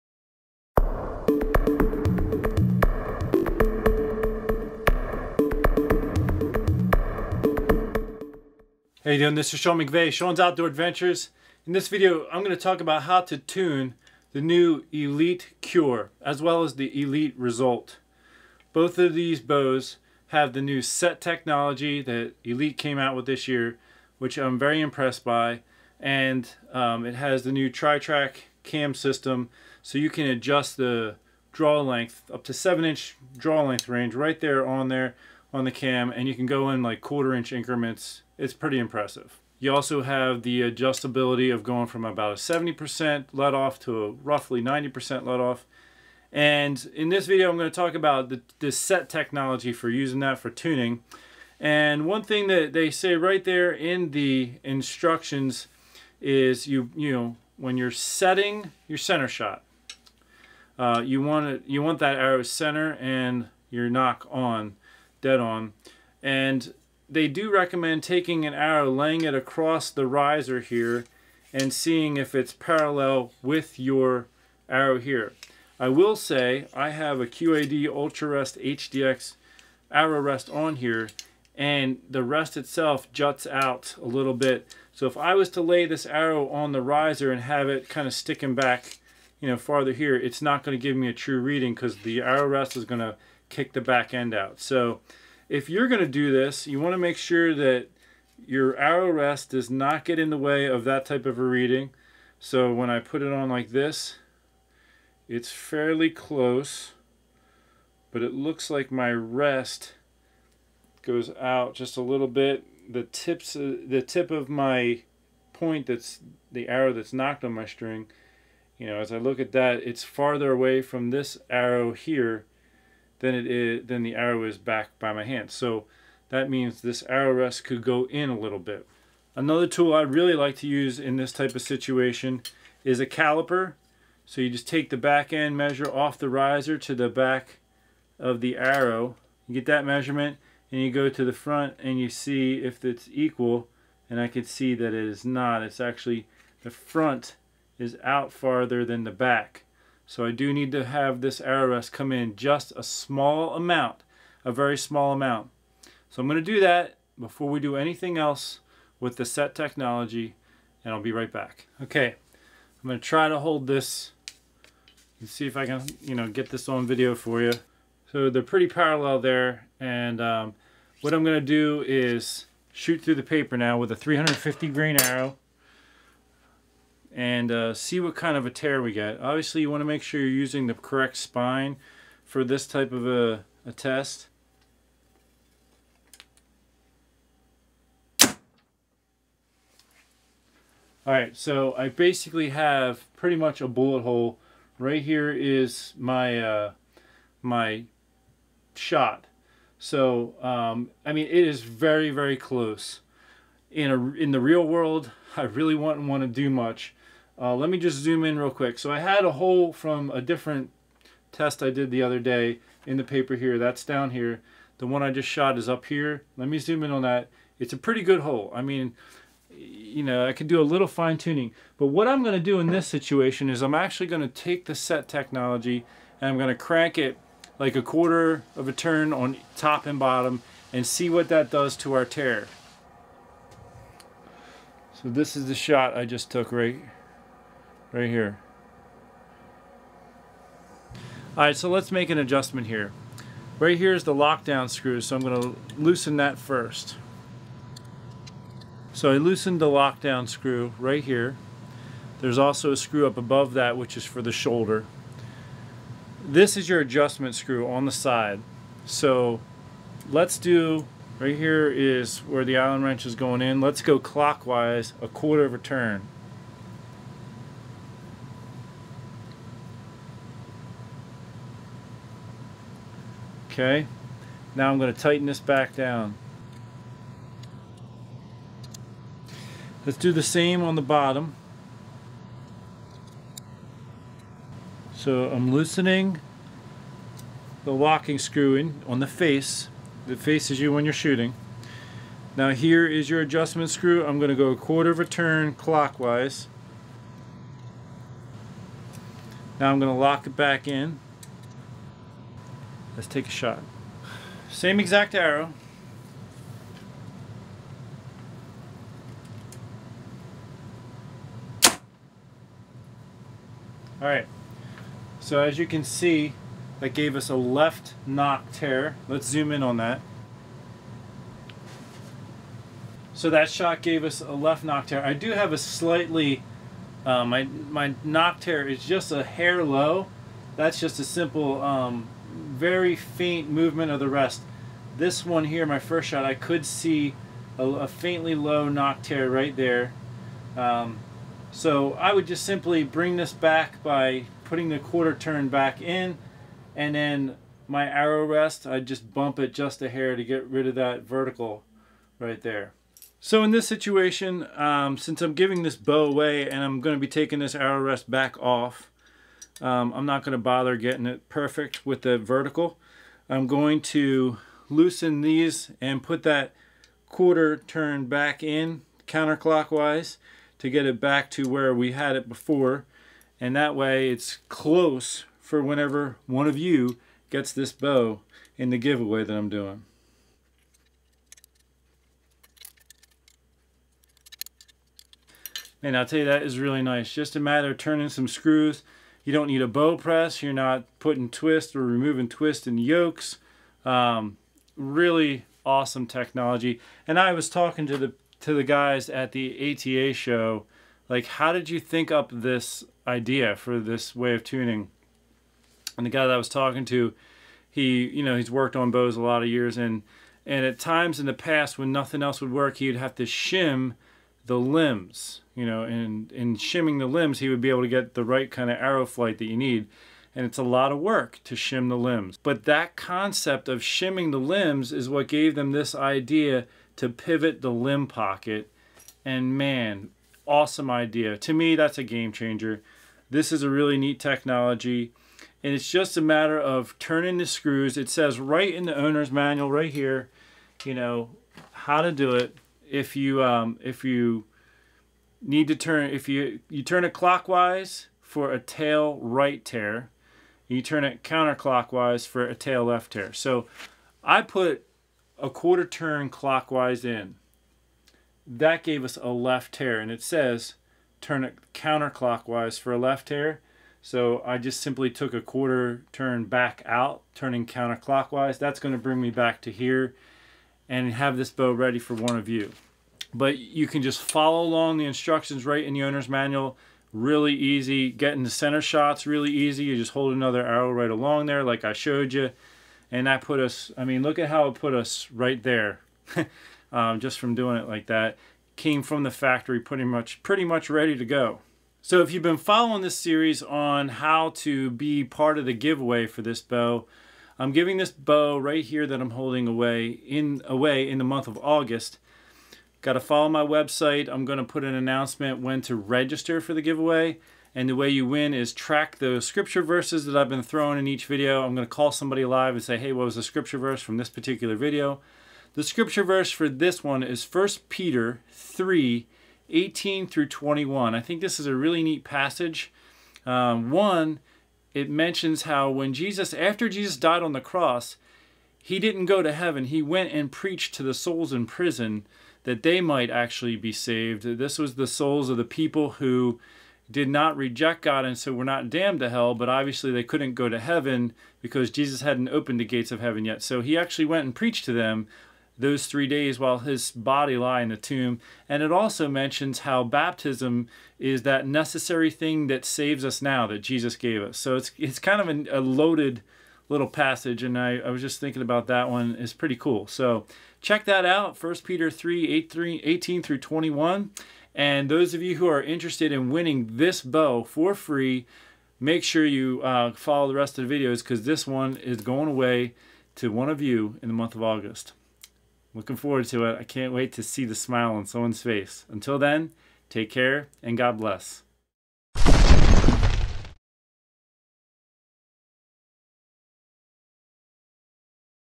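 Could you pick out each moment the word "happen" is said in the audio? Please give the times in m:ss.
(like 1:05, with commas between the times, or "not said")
not said.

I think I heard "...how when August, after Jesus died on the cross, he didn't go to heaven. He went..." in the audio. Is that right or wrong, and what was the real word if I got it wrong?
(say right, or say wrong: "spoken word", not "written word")
wrong: "Jesus", not "August".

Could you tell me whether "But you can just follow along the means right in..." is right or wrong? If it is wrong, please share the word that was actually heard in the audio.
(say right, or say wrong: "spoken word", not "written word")
wrong: "instructions", not "means".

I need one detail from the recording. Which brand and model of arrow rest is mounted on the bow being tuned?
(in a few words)
QAD UltraRest HDX.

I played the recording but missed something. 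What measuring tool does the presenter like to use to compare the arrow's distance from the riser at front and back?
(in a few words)
caliper.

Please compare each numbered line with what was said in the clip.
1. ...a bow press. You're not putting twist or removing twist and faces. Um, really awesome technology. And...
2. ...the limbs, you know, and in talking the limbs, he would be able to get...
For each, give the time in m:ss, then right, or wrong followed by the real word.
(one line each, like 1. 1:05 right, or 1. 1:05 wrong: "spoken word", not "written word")
1. 6:29 wrong: "yokes", not "faces"
2. 6:54 wrong: "shimming", not "talking".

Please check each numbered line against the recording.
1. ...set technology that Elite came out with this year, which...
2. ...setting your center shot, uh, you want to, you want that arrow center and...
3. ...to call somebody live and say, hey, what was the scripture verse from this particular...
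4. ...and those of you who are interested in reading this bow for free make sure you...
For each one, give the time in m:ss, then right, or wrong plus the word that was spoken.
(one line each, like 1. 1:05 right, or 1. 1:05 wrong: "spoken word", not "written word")
1. 0:20 right
2. 0:57 right
3. 8:31 right
4. 9:24 wrong: "winning", not "reading".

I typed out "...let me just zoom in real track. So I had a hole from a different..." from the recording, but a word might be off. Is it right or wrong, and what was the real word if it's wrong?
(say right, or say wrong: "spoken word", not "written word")
wrong: "quick", not "track".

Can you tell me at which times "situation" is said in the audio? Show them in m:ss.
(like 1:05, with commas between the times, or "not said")
2:11, 3:42, 5:53.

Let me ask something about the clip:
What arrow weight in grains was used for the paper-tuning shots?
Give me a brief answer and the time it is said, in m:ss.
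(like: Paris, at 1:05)
350 grain, at 2:53.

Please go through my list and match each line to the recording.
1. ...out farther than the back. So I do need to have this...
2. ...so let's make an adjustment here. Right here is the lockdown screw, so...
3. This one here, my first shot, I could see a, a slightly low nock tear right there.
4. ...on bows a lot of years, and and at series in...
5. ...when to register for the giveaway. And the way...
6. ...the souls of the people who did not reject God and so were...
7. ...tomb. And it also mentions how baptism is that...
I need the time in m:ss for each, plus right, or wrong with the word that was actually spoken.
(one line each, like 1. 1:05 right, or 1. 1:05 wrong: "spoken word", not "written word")
1. 2:28 right
2. 4:01 right
3. 5:34 wrong: "faintly", not "slightly"
4. 6:48 wrong: "times", not "series"
5. 8:25 right
6. 8:54 right
7. 9:07 right.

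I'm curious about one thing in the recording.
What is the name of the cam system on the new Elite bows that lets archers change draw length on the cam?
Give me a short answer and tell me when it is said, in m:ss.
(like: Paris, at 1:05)
tri-track cam system, at 0:27.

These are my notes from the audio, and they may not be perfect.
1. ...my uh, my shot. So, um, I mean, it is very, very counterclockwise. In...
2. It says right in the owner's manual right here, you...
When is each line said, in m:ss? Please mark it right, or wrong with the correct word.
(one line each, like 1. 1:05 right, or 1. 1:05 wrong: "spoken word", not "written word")
1. 3:15 wrong: "close", not "counterclockwise"
2. 7:17 right.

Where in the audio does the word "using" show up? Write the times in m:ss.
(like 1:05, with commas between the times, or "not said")
0:49, 3:00.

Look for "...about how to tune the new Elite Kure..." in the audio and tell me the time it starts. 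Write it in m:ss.
0:12.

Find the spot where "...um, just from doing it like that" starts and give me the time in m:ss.
8:06.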